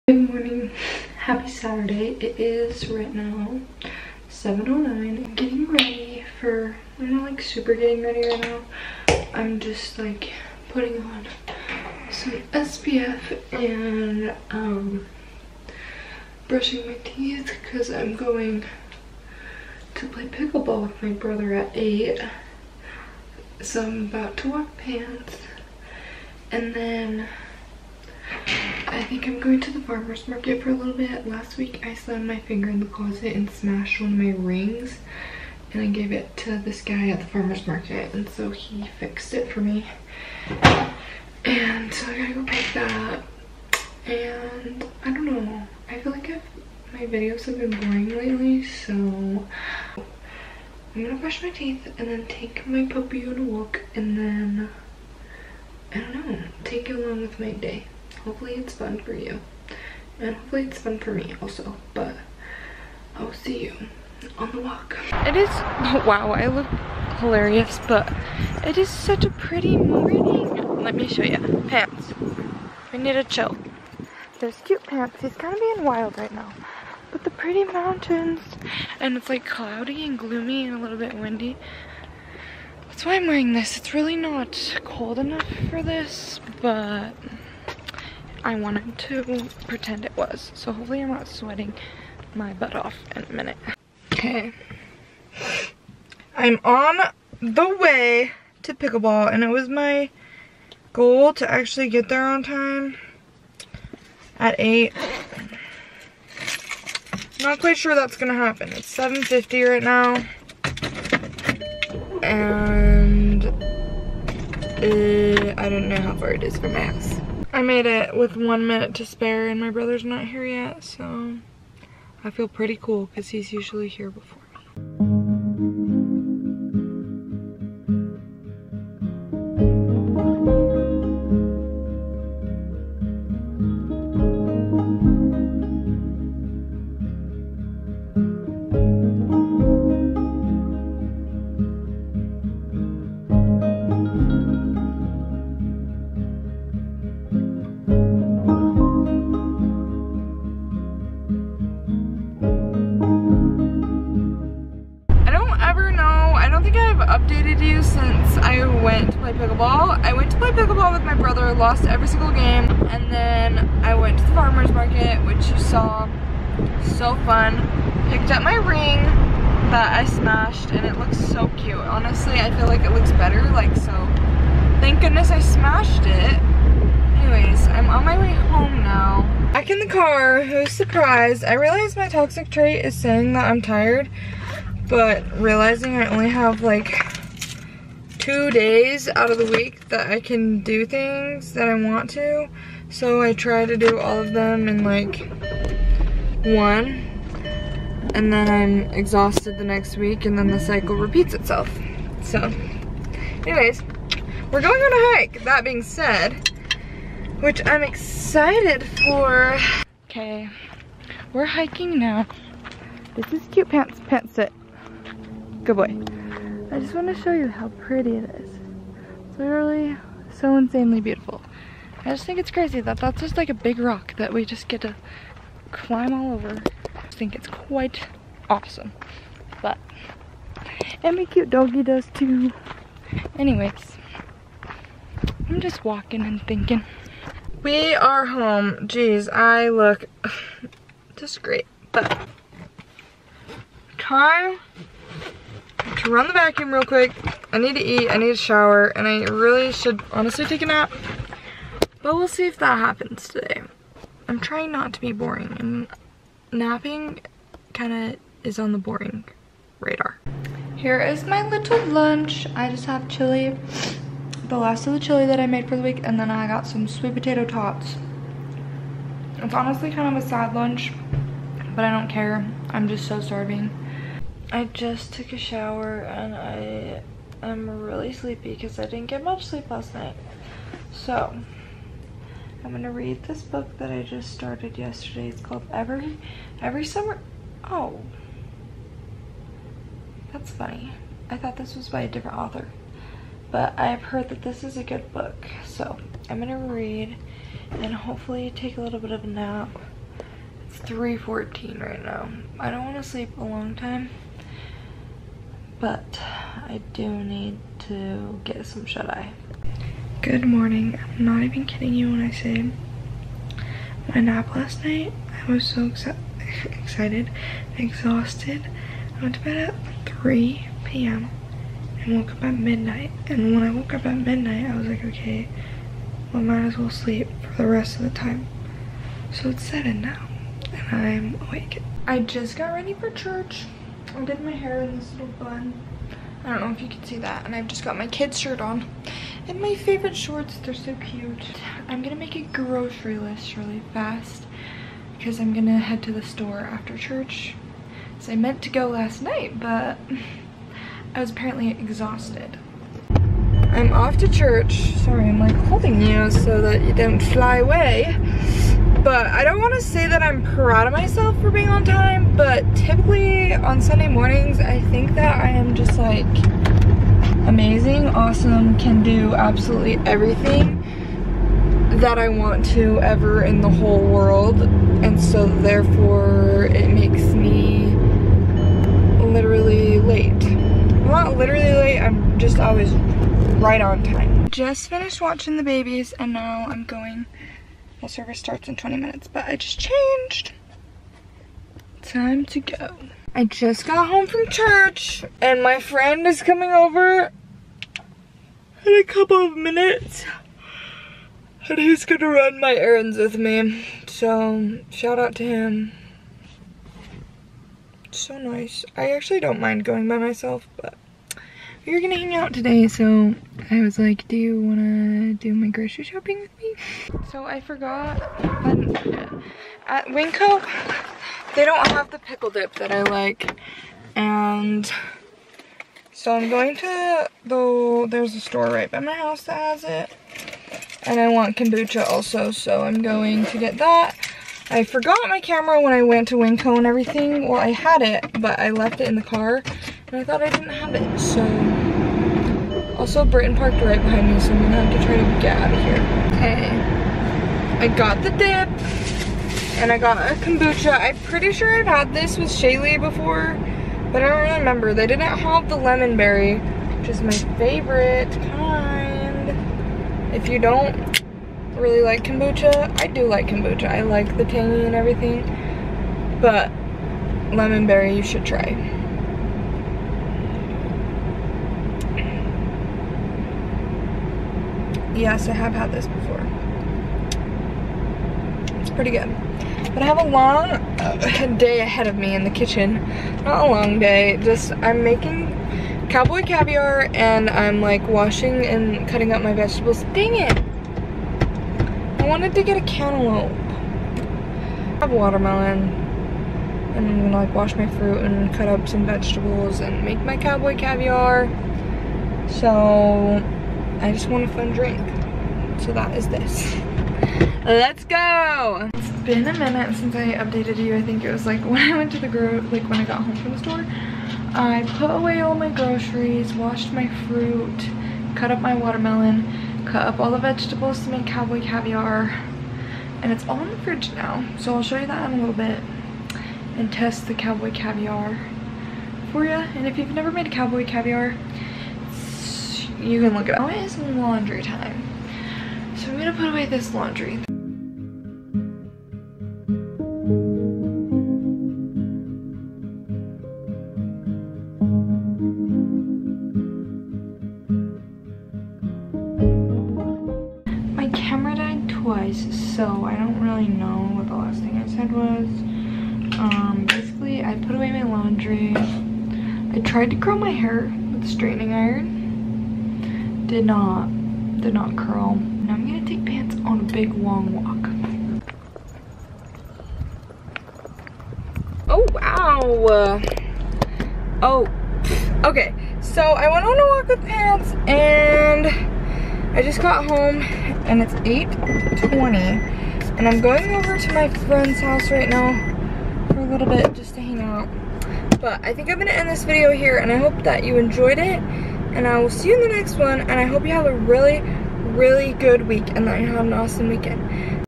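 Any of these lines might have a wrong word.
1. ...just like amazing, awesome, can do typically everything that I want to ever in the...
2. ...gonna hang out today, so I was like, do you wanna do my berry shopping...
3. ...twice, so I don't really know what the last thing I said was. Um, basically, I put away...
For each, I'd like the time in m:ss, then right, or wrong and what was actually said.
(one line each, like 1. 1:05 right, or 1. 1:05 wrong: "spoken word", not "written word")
1. 6:05 wrong: "absolutely", not "typically"
2. 6:51 wrong: "grocery", not "berry"
3. 9:11 right.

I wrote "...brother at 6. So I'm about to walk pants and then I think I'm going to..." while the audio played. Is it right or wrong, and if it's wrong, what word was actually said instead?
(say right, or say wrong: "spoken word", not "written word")
wrong: "8", not "6".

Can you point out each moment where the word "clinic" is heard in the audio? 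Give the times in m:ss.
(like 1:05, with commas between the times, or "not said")
not said.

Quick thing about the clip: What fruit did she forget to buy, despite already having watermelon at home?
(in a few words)
cantaloupe.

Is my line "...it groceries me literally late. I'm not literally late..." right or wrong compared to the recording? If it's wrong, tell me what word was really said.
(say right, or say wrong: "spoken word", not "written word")
wrong: "makes", not "groceries".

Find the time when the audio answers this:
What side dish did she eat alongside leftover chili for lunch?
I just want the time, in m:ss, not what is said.
4:26.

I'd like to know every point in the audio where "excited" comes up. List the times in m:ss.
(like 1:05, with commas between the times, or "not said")
3:27, 5:16.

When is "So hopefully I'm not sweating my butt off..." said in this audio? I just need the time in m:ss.
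1:30.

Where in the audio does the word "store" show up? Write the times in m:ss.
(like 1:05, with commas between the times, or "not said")
5:46, 7:08, 8:33.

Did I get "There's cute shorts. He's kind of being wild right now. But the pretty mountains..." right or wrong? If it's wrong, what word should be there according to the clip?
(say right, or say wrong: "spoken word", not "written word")
wrong: "pants", not "shorts".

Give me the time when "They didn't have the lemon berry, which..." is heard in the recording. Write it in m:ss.
7:34.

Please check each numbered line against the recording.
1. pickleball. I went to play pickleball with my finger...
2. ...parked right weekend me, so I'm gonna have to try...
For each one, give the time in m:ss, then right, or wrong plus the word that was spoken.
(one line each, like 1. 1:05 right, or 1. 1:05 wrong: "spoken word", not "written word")
1. 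2:39 wrong: "brother", not "finger"
2. 7:23 wrong: "behind", not "weekend".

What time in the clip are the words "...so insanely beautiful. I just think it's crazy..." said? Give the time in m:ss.
3:40.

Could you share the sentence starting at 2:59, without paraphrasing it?
Back in the car, who's surprised?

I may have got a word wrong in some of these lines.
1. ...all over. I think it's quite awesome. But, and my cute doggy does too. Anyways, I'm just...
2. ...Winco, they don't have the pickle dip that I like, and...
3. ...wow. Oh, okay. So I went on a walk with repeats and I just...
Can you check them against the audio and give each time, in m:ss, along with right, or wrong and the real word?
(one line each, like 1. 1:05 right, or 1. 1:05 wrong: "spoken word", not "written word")
1. 3:46 right
2. 7:00 right
3. 9:32 wrong: "pants", not "repeats".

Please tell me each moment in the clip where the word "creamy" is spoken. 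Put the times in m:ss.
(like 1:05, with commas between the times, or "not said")
not said.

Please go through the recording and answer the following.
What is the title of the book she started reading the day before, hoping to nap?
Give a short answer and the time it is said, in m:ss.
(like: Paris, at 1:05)
Every Summer, at 4:45.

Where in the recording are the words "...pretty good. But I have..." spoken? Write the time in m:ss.
7:58.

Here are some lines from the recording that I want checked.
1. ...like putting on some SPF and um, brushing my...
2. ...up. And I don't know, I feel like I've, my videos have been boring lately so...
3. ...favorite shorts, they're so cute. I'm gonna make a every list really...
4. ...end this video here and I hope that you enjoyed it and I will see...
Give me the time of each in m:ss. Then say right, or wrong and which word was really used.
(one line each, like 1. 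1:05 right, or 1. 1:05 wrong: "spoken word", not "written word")
1. 0:09 right
2. 0:43 right
3. 5:39 wrong: "grocery", not "every"
4. 9:49 right.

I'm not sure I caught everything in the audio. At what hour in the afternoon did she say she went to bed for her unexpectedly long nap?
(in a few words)
3 p.m.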